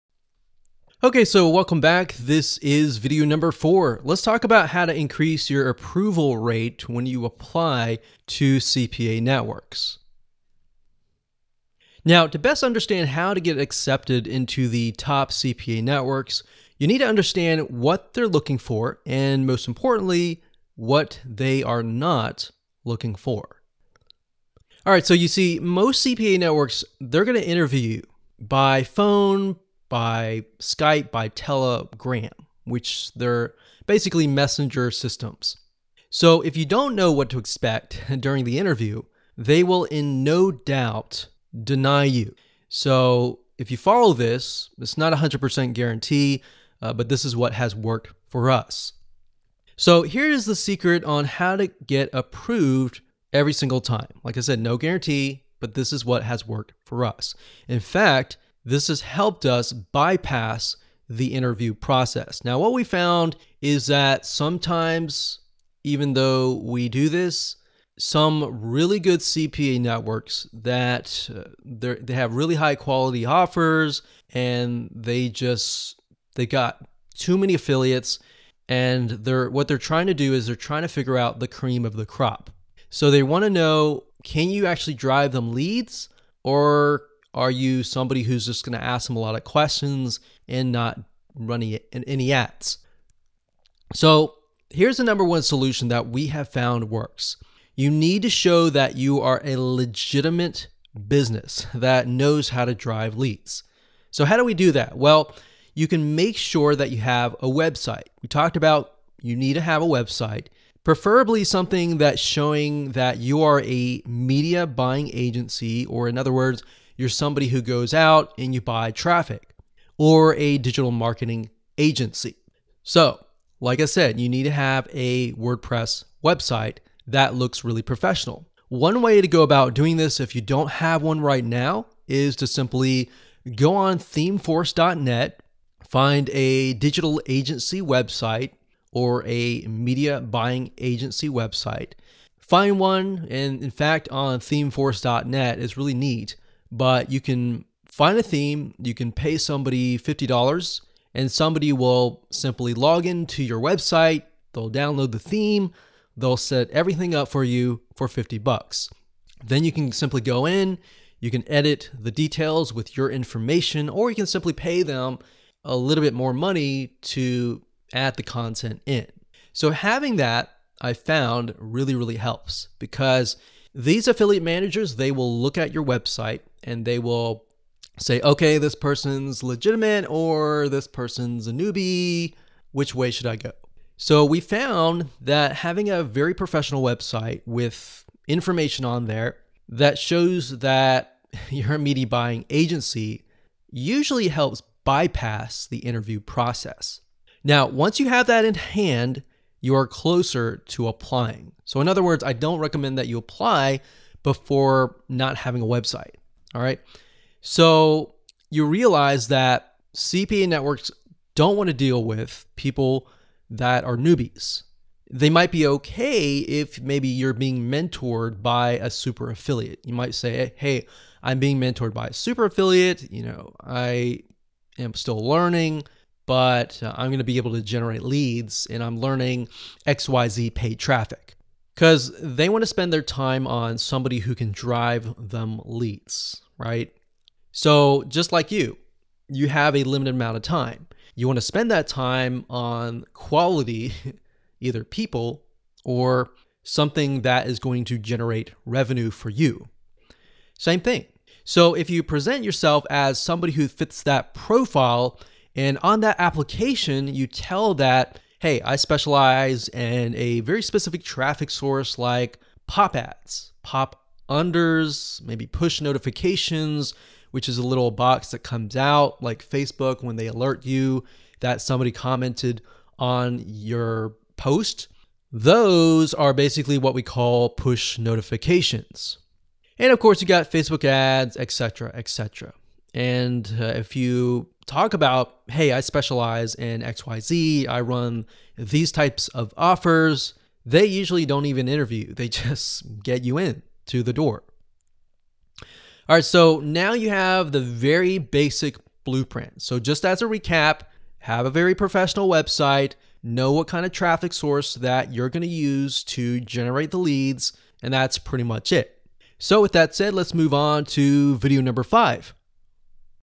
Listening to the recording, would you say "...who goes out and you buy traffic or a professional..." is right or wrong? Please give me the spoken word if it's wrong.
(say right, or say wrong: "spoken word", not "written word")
wrong: "digital", not "professional".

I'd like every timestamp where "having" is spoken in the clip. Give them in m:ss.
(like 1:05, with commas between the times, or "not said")
2:49, 3:05, 3:25.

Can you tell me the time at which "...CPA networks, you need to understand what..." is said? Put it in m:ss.
0:15.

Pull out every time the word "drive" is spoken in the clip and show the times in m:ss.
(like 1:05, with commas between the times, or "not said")
1:24, 1:42, 3:54.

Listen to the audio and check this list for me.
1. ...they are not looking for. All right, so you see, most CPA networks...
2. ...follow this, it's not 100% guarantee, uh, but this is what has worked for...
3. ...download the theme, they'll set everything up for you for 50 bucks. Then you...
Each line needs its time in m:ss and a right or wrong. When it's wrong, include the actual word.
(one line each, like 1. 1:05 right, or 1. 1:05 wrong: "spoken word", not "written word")
1. 0:21 right
2. 0:43 right
3. 2:34 right.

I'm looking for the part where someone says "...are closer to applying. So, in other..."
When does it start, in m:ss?
3:19.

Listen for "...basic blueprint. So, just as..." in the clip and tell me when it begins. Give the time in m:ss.
4:58.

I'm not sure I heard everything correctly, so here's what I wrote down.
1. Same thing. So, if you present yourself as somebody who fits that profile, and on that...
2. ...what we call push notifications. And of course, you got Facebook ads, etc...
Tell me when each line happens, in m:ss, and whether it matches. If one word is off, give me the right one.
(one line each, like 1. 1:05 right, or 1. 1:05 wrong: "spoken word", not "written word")
1. 4:10 right
2. 4:36 right.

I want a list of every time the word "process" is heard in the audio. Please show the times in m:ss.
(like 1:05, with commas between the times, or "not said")
1:01, 3:16.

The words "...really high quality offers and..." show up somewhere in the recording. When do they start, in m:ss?
1:12.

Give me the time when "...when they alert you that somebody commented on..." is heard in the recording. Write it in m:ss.
4:30.